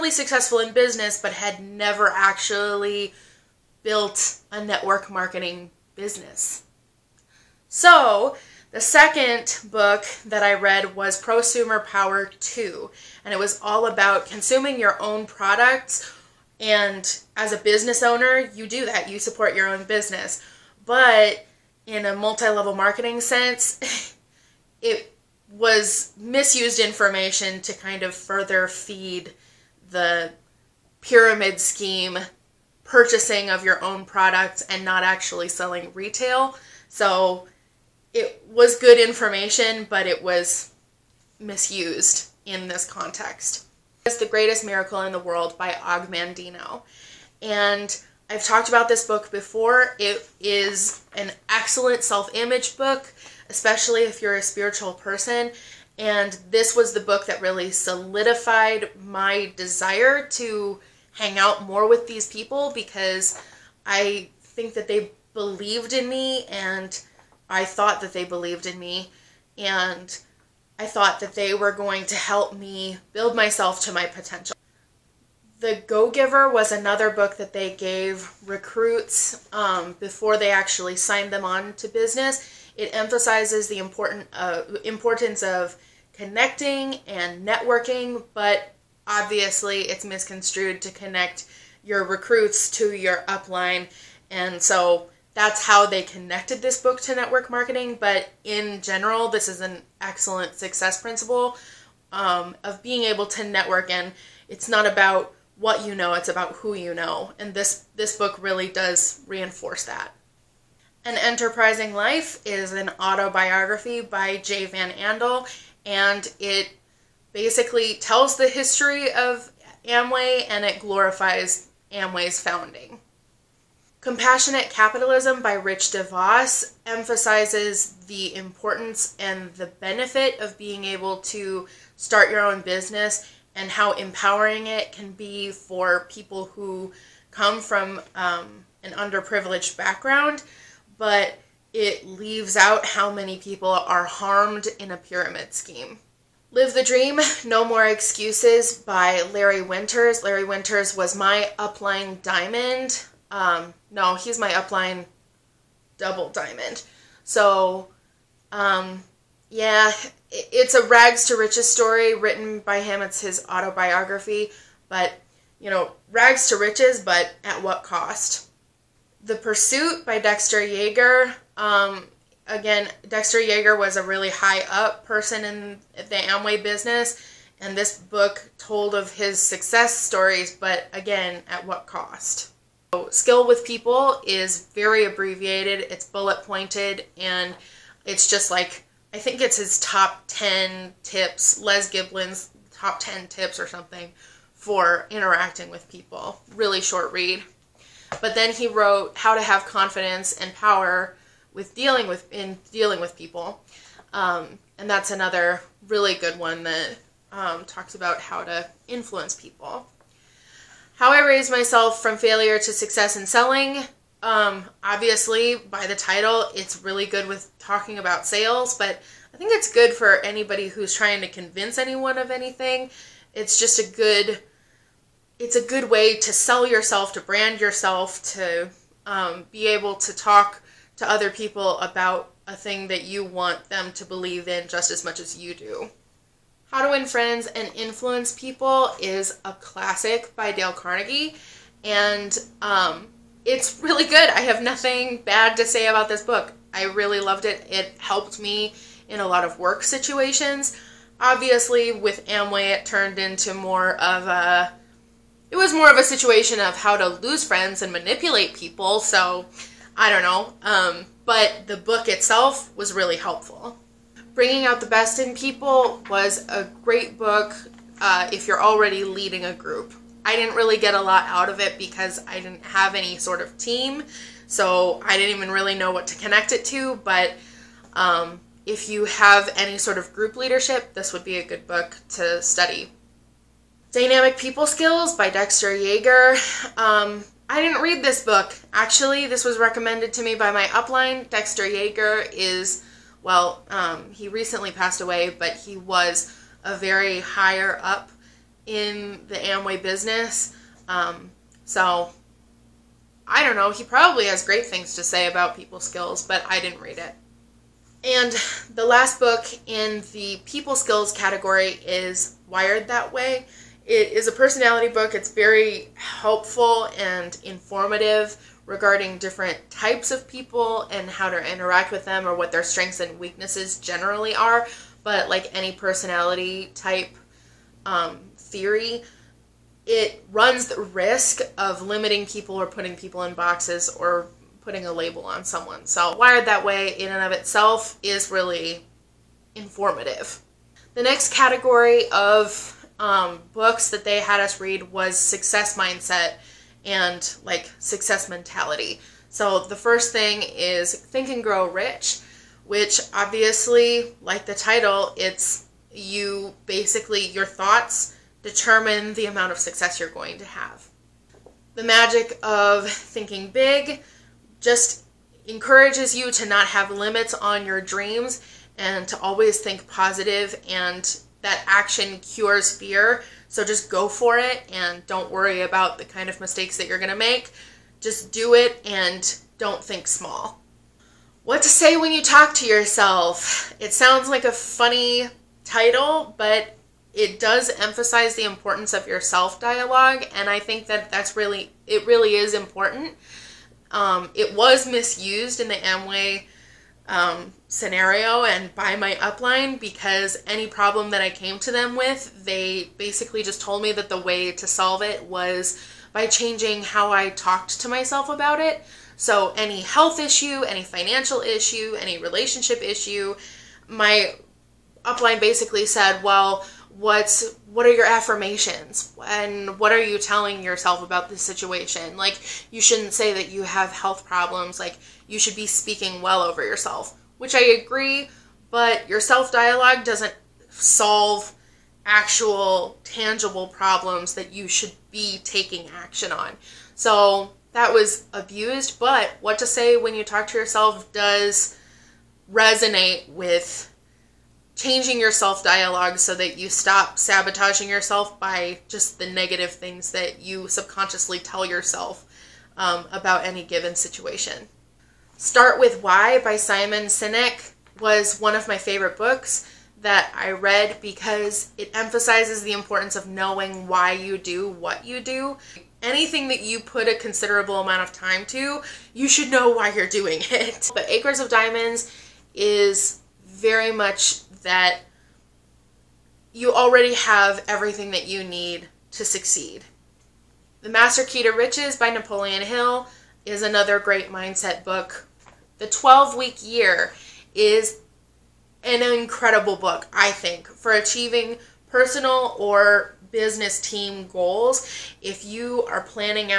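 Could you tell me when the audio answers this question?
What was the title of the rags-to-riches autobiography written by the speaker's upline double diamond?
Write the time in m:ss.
2:26.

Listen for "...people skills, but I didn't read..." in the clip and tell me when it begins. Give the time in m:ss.
5:05.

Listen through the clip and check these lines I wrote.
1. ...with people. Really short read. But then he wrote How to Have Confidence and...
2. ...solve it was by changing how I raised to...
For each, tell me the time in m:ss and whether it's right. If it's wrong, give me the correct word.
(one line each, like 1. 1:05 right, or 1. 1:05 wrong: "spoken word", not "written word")
1. 3:15 right
2. 6:44 wrong: "talked", not "raised".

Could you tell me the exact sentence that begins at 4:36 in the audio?
But um, if you have any sort of group leadership, this would be a good book to study.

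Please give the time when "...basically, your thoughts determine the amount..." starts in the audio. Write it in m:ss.
5:56.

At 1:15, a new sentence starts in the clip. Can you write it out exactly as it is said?
The Go Giver was another book that they gave recruits um, before they actually signed them on to business.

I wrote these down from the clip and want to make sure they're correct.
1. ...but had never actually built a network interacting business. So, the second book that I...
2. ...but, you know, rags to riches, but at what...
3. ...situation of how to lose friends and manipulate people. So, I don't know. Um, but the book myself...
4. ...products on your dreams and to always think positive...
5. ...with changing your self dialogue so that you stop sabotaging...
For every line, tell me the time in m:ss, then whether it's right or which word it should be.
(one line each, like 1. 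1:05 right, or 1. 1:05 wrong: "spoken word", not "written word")
1. 0:01 wrong: "marketing", not "interacting"
2. 2:44 right
3. 4:16 wrong: "itself", not "myself"
4. 6:06 wrong: "limits", not "products"
5. 7:23 right.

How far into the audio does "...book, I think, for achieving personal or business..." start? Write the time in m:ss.
8:09.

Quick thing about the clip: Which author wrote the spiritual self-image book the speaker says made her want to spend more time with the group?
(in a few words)
Og Mandino.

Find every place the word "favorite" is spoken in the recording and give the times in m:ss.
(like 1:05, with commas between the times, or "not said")
7:38.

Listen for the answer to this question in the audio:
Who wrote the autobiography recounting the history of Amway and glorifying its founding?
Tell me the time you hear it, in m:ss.
1:54.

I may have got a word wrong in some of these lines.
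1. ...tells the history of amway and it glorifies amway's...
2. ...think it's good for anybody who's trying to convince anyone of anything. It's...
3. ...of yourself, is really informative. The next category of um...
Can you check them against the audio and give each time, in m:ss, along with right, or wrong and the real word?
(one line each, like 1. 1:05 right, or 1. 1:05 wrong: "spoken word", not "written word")
1. 1:57 right
2. 3:39 right
3. 5:37 wrong: "itself", not "yourself".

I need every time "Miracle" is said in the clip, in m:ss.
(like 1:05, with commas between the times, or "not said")
0:44.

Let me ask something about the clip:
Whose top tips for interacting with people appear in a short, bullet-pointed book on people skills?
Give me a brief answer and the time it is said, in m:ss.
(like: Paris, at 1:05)
Les Giblin, at 3:11.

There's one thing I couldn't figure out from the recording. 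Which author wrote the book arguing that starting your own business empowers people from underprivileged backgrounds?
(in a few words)
Rich DeVos.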